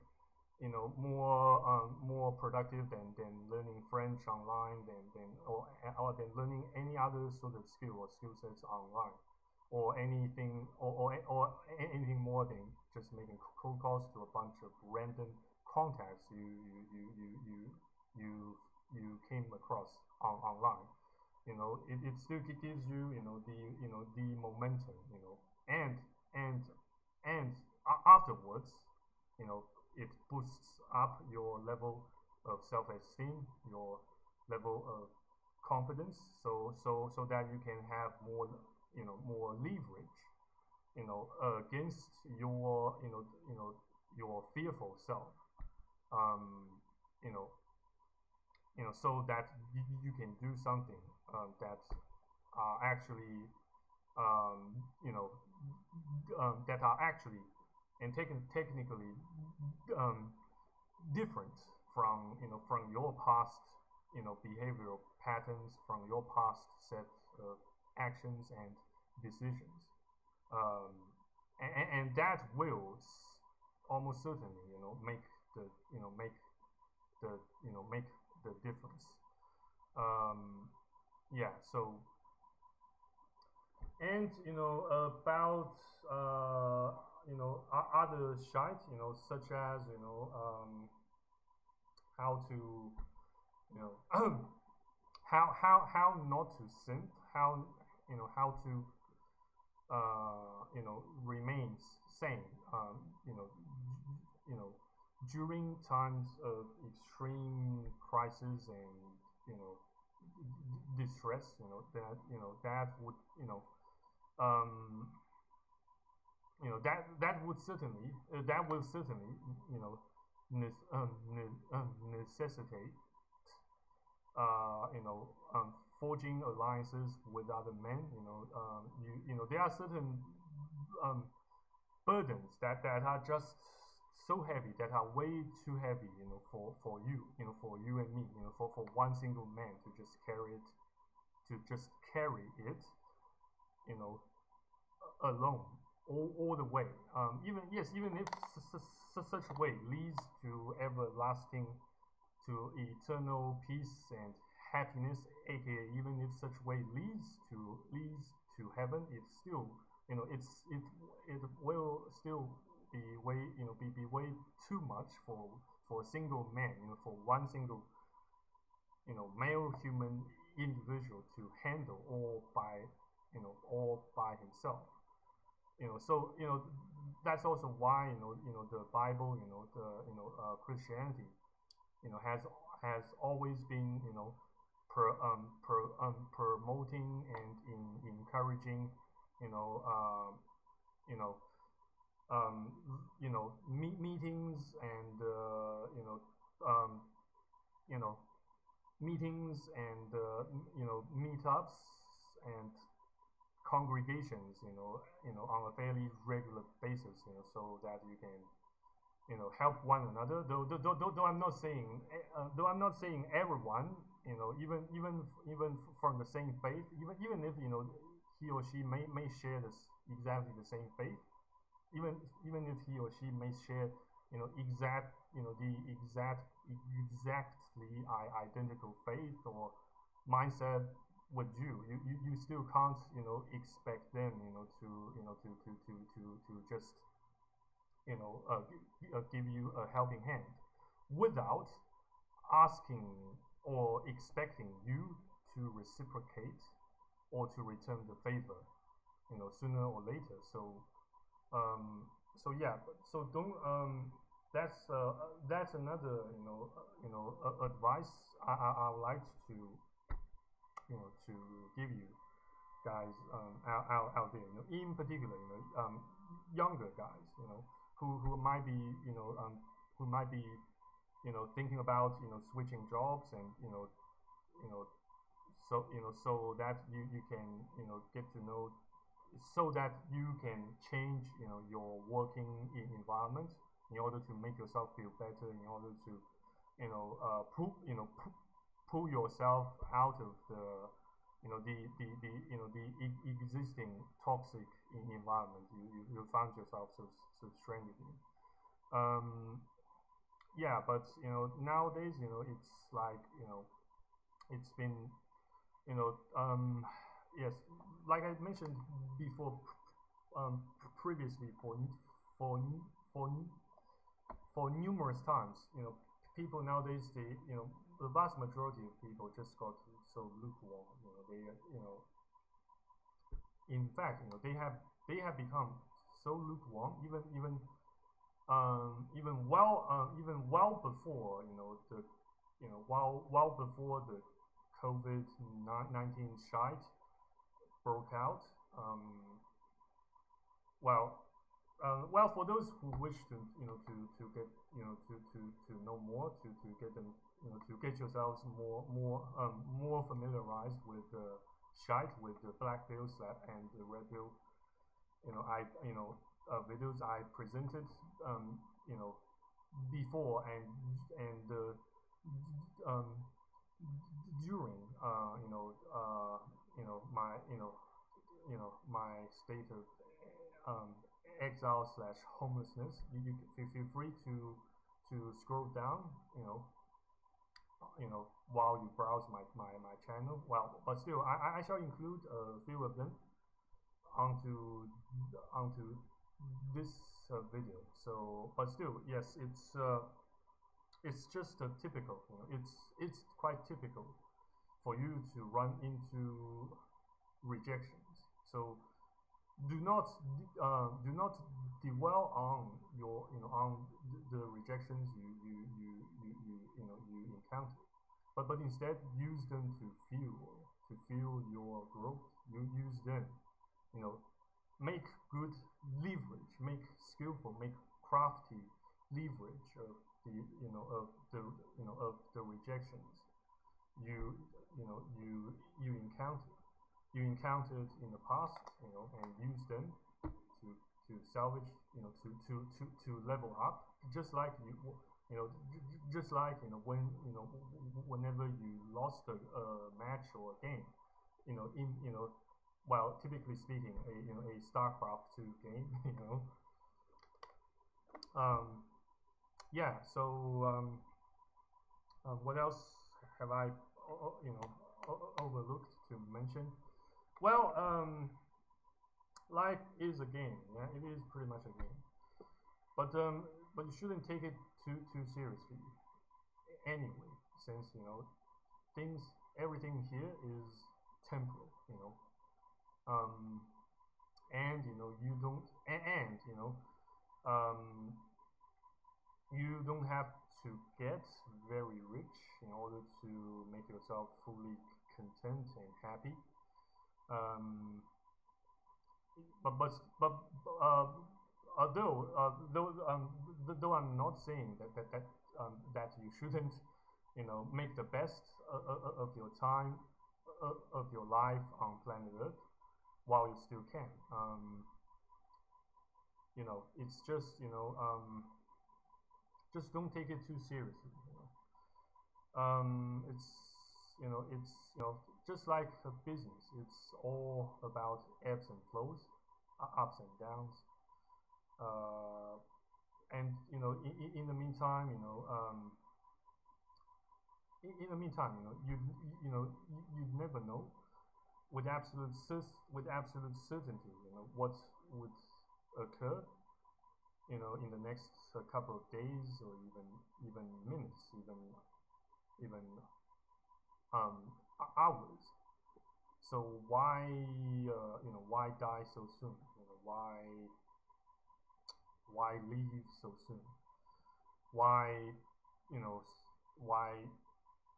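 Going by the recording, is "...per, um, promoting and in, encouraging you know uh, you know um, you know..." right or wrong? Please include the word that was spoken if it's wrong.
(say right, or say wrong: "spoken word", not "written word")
right.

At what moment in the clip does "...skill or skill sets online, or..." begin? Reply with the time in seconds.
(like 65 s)
7 s.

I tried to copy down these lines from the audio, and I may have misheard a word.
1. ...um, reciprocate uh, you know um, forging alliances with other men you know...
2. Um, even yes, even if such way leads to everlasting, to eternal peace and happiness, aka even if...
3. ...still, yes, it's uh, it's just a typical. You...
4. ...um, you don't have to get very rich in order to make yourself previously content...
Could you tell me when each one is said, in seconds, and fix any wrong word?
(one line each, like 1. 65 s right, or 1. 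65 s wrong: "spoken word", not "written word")
1. 121 s wrong: "necessitate", not "reciprocate"
2. 147 s right
3. 388 s right
4. 477 s wrong: "fully", not "previously".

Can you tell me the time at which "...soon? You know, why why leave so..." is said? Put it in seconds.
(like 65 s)
549 s.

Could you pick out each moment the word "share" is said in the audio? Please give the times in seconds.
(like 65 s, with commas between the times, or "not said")
219 s, 223 s.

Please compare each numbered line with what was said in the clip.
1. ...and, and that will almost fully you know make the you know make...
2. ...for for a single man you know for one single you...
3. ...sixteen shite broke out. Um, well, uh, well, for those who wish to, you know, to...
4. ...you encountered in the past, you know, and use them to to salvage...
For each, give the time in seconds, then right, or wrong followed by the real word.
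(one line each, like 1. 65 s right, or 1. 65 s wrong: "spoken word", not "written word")
1. 71 s wrong: "certainly", not "fully"
2. 165 s right
3. 335 s wrong: "nineteen", not "sixteen"
4. 427 s right.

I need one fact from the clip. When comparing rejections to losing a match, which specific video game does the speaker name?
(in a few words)
StarCraft 2.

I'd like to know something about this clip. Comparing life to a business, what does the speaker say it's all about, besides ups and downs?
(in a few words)
ebbs and flows.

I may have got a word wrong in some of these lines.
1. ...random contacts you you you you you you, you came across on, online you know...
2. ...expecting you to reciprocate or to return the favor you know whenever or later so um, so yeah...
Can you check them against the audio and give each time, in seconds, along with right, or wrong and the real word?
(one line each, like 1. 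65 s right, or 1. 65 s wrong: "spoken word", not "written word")
1. 14 s right
2. 244 s wrong: "sooner", not "whenever".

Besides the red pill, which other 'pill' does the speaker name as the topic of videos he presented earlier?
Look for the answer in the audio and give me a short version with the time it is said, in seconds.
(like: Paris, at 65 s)
black pill, at 352 s.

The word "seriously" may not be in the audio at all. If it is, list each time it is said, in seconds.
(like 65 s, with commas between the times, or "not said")
465 s, 510 s.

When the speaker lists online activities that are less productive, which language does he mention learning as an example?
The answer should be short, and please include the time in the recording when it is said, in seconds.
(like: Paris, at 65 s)
French, at 3 s.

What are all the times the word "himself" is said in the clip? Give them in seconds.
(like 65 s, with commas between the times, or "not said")
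174 s.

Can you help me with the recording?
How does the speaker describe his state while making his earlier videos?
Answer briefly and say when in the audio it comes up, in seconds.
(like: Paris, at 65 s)
exile slash homelessness, at 371 s.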